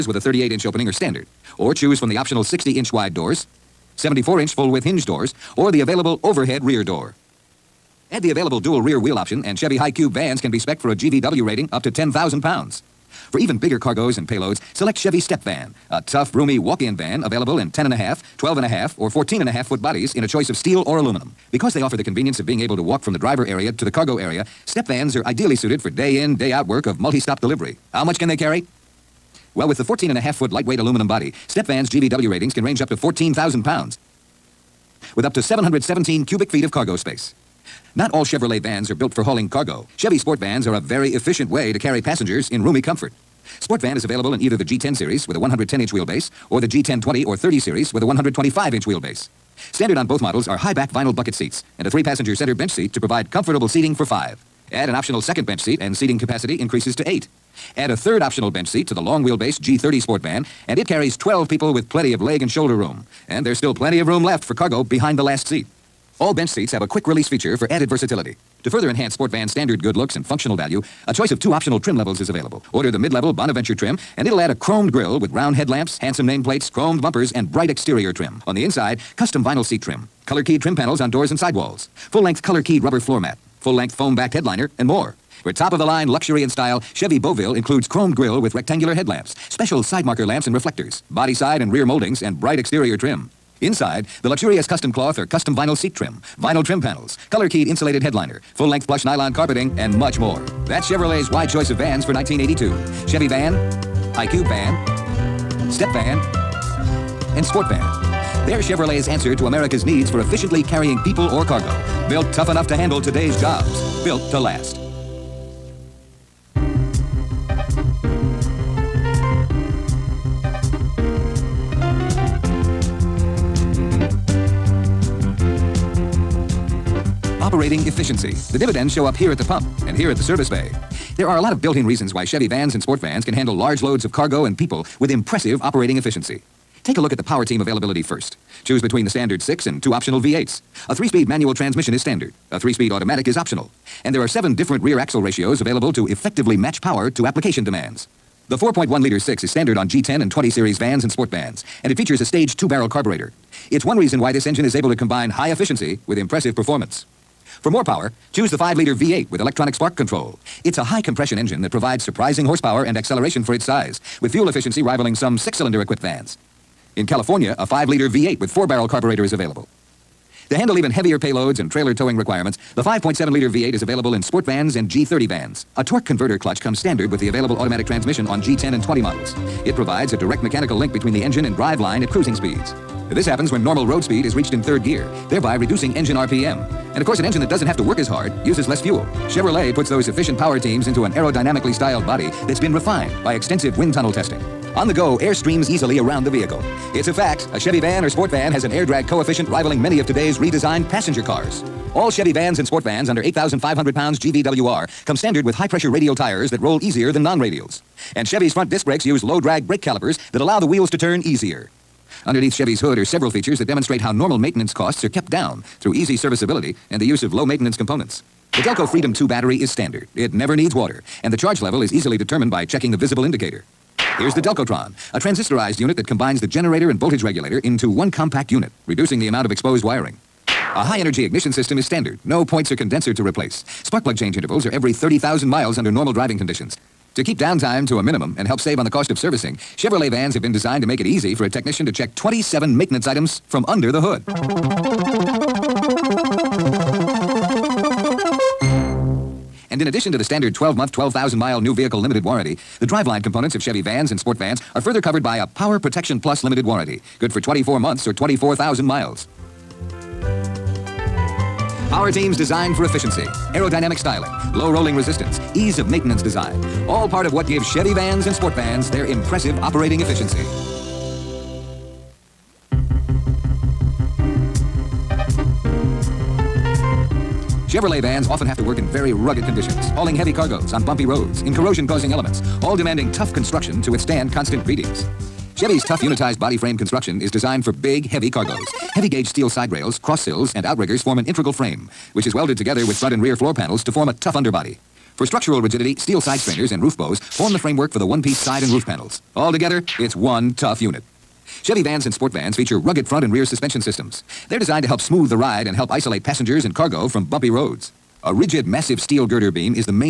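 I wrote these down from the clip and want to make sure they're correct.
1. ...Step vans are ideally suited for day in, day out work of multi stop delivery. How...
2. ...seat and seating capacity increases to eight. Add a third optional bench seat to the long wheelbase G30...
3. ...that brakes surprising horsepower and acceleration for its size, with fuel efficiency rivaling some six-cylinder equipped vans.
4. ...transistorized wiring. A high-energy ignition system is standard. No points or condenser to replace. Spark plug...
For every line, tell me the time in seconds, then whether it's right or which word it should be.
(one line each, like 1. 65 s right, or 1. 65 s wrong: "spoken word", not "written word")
1. 24 s right
2. 55 s right
3. 161 s wrong: "provides", not "brakes"
4. 229 s wrong: "exposed", not "transistorized".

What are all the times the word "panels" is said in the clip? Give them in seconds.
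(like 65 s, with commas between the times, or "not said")
80 s, 96 s, 293 s, 298 s.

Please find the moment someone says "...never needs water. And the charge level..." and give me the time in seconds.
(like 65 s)
220 s.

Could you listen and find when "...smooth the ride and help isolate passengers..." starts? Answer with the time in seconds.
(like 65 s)
304 s.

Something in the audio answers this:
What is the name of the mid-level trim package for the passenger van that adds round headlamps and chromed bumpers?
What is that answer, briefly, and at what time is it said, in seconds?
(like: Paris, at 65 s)
Bonaventure, at 73 s.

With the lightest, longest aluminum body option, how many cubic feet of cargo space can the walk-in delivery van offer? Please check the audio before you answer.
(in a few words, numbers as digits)
717.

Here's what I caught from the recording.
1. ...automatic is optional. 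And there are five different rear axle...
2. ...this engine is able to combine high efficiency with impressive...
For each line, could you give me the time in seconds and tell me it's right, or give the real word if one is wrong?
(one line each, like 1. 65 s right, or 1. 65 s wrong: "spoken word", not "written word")
1. 142 s wrong: "seven", not "five"
2. 154 s right.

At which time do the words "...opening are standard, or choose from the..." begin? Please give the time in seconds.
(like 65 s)
0 s.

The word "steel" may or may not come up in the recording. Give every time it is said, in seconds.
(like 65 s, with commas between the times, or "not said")
20 s, 289 s, 295 s, 308 s.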